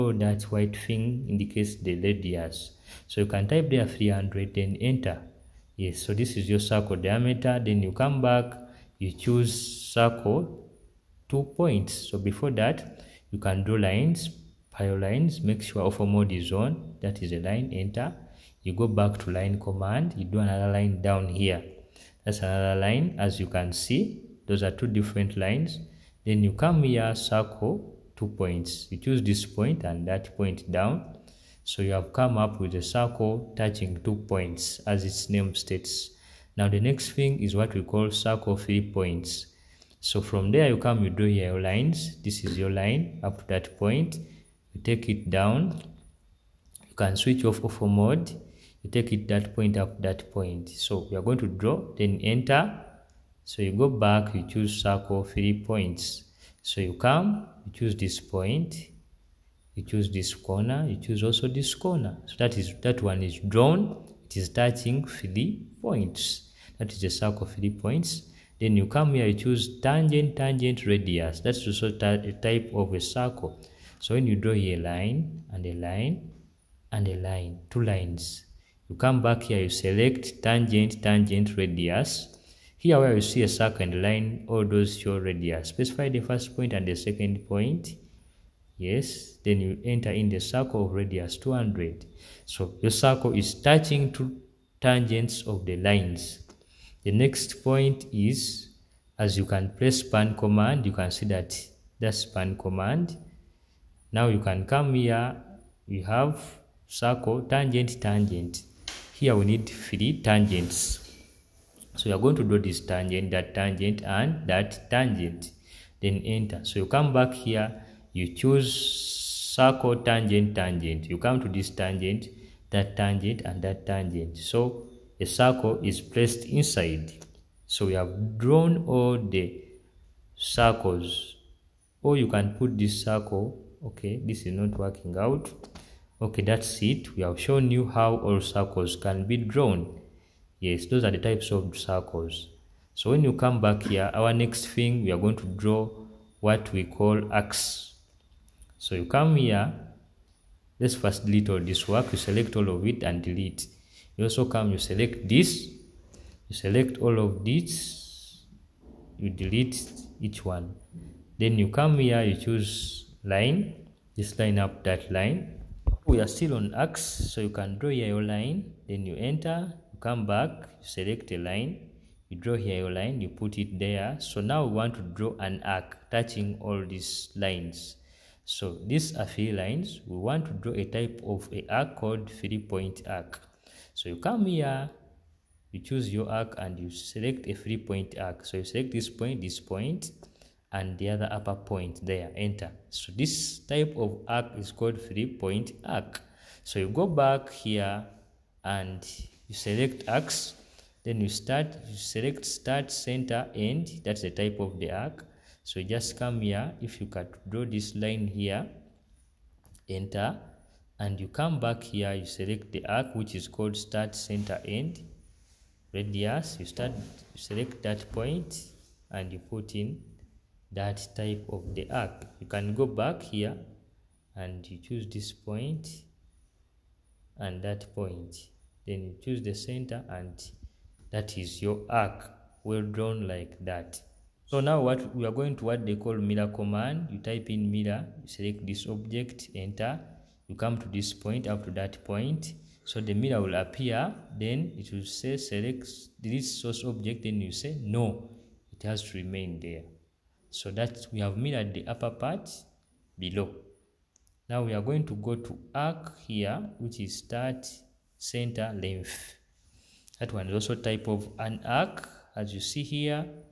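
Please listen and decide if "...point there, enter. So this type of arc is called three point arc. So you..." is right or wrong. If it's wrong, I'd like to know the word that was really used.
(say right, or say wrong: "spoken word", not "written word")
right.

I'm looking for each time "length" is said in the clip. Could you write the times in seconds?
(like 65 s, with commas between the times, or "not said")
258 s.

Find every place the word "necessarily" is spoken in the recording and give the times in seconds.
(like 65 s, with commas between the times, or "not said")
not said.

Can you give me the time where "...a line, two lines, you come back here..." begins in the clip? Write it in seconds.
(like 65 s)
77 s.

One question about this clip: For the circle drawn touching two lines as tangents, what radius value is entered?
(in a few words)
200.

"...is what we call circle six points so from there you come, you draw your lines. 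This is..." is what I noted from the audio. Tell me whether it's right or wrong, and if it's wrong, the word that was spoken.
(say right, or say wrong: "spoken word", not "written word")
wrong: "three", not "six".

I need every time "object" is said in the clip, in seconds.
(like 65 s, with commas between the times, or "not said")
238 s, 246 s.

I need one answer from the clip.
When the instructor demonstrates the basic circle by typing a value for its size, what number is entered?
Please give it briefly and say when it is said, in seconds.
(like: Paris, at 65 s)
300, at 3 s.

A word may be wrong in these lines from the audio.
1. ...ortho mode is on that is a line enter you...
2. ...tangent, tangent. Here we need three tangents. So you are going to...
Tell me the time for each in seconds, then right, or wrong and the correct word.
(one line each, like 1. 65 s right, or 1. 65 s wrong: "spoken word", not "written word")
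1. 15 s right
2. 107 s right.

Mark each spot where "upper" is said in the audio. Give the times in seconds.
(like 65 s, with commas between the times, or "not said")
191 s, 251 s.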